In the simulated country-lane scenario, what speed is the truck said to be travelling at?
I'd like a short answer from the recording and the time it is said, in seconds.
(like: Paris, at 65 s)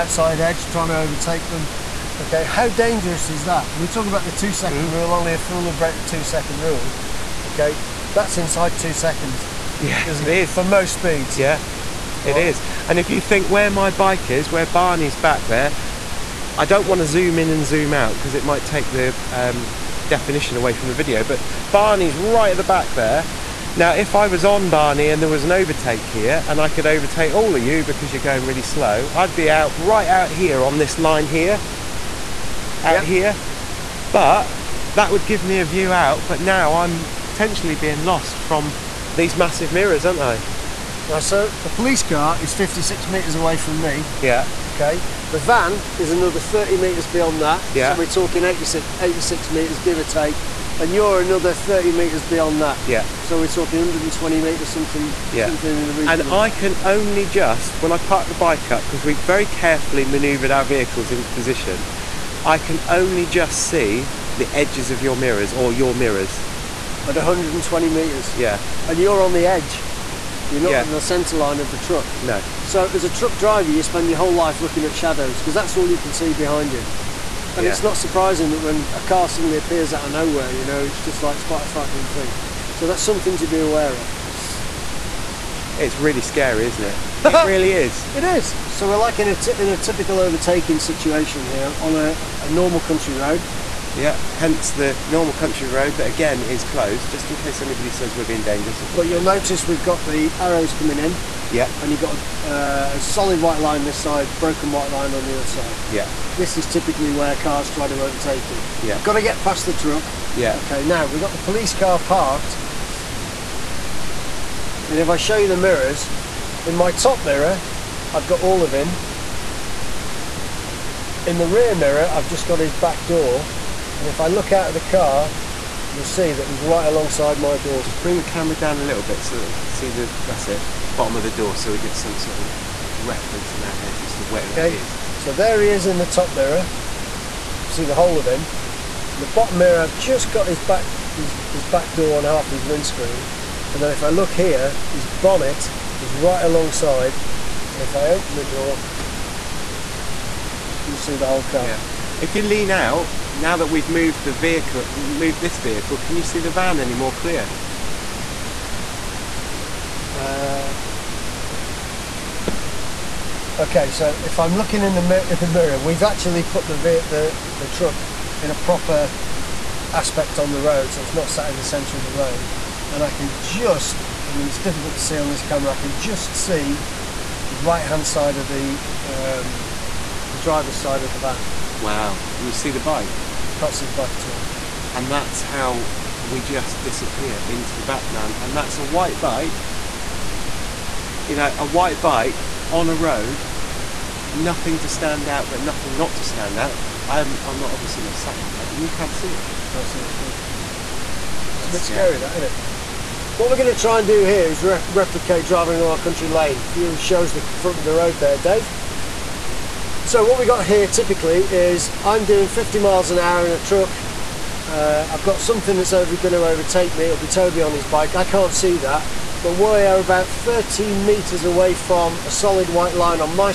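50 miles an hour, at 212 s.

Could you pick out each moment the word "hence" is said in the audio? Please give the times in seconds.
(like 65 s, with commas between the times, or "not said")
94 s.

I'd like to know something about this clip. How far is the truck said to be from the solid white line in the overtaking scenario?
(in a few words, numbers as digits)
13 metres.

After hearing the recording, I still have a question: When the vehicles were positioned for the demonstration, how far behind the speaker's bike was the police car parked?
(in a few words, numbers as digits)
56 metres.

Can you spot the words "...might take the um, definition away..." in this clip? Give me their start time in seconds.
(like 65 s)
18 s.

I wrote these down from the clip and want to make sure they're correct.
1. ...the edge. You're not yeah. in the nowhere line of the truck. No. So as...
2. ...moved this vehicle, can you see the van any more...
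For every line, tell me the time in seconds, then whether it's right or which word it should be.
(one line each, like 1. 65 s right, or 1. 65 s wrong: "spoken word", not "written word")
1. 69 s wrong: "centre", not "nowhere"
2. 154 s right.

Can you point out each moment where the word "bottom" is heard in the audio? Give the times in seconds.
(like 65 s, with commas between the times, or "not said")
130 s, 139 s.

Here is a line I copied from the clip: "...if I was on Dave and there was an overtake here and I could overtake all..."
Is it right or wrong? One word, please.
wrong.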